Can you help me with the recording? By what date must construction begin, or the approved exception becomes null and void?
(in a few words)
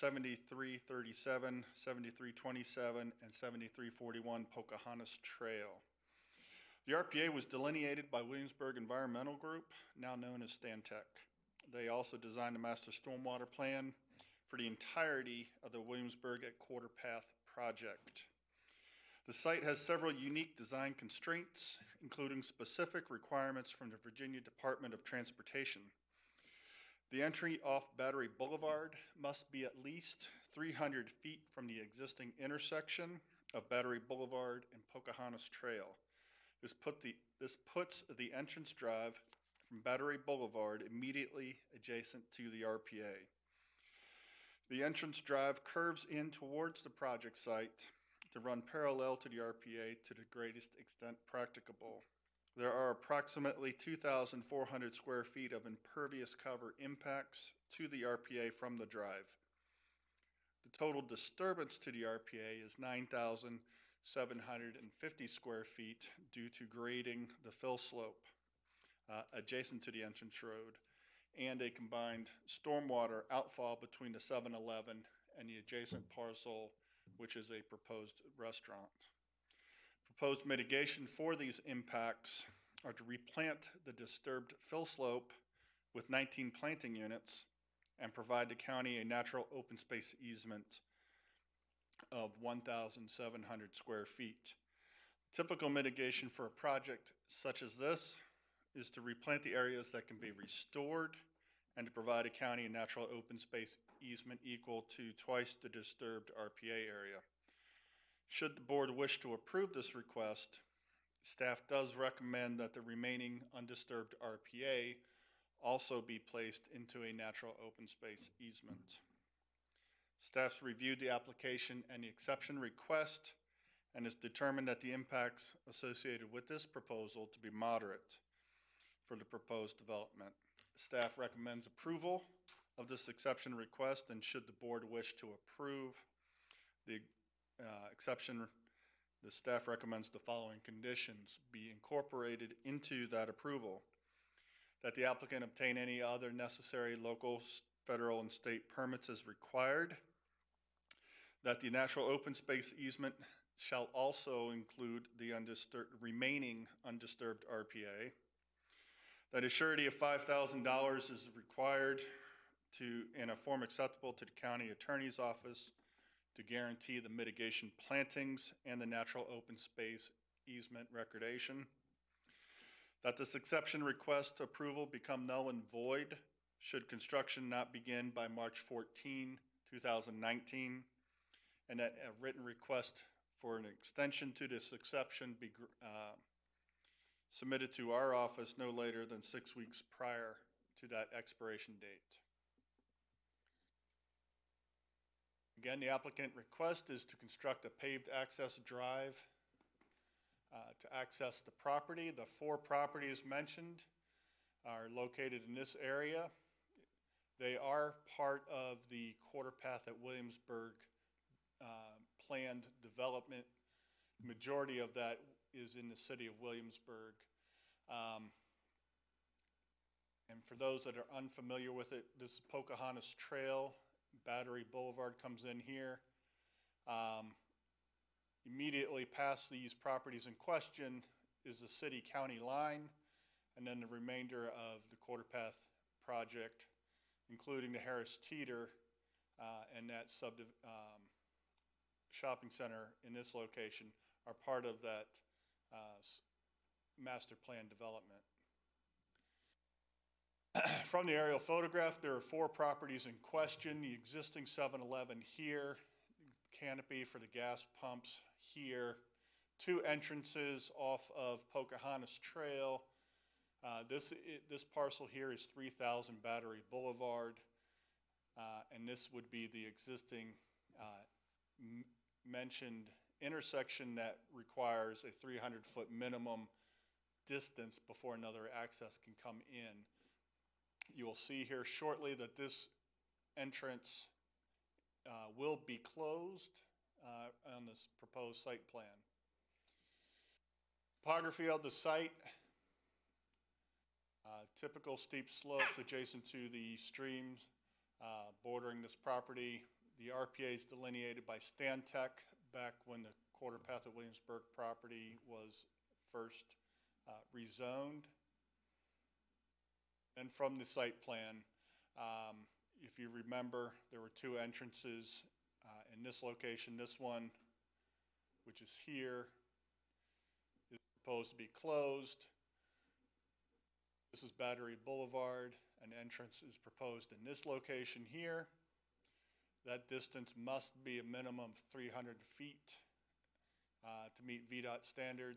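March 14, 2019.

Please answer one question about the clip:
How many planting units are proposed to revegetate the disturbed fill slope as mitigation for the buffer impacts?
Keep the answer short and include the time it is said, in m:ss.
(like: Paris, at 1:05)
19, at 1:26.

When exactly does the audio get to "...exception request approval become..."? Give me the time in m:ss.
2:53.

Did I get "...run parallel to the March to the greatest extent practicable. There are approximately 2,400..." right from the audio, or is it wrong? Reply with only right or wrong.
wrong.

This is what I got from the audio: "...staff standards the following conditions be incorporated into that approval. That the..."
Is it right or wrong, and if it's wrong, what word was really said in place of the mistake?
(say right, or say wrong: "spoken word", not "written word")
wrong: "recommends", not "standards".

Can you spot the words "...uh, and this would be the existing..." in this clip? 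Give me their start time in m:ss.
4:28.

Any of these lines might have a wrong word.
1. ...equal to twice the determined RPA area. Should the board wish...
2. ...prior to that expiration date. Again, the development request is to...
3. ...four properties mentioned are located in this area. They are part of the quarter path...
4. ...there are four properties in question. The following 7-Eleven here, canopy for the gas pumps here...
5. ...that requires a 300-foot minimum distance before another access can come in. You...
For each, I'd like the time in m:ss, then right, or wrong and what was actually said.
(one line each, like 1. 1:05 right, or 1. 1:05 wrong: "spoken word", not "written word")
1. 1:44 wrong: "disturbed", not "determined"
2. 3:09 wrong: "applicant", not "development"
3. 3:22 right
4. 4:12 wrong: "existing", not "following"
5. 4:33 right.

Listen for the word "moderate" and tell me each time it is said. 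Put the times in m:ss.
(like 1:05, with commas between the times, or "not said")
2:07.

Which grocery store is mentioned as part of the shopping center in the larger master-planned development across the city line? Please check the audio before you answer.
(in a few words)
Harris Teeter.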